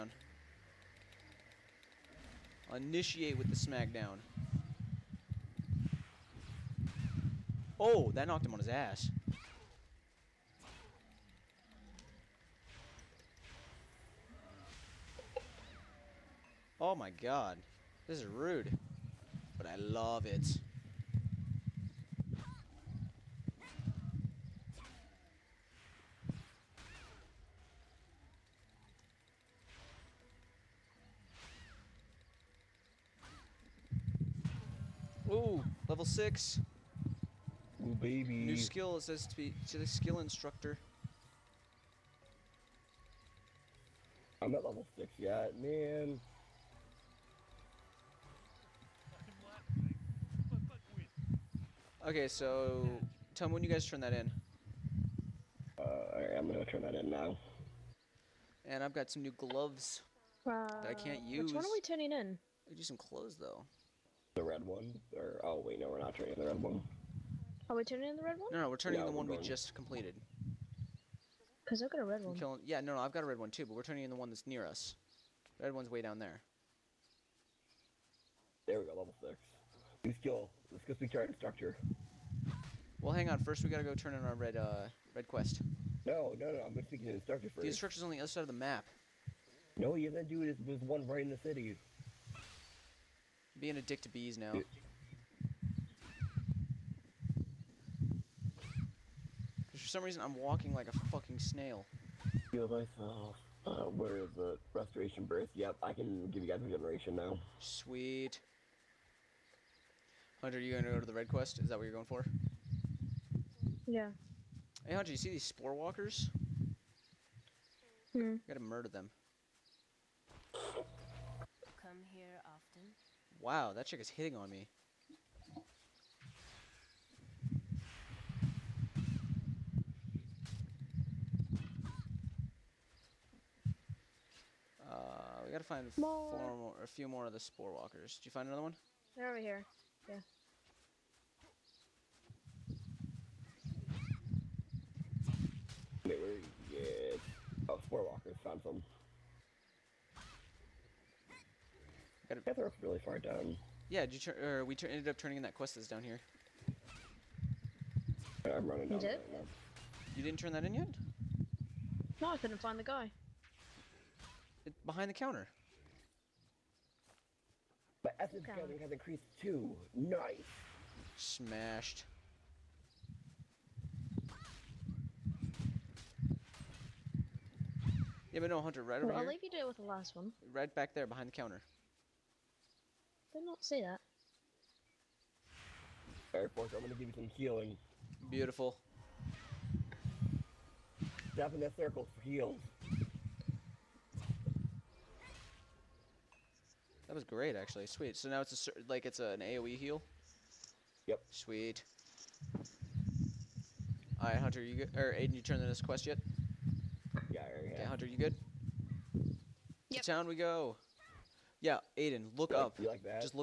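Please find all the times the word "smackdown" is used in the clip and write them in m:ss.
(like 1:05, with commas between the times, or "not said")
0:03.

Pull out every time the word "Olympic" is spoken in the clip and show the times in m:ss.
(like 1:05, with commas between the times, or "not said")
not said.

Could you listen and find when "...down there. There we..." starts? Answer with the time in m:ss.
1:16.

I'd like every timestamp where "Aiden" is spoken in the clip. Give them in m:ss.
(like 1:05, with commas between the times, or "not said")
3:25, 3:31.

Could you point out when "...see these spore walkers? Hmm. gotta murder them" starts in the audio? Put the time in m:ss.
1:55.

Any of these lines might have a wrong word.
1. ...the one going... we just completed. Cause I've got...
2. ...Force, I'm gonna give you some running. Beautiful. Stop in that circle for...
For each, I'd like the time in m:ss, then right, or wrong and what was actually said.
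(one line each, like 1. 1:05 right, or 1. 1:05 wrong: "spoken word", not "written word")
1. 1:09 right
2. 3:06 wrong: "healing", not "running".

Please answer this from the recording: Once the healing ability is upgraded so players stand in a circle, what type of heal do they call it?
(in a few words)
AOE heal.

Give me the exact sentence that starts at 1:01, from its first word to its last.
Which one are we turning in?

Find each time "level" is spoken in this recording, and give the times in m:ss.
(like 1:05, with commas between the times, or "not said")
0:35, 0:44, 1:18.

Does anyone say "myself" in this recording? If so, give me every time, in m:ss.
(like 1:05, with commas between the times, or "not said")
1:42.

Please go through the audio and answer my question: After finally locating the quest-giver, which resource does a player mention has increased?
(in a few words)
Essence.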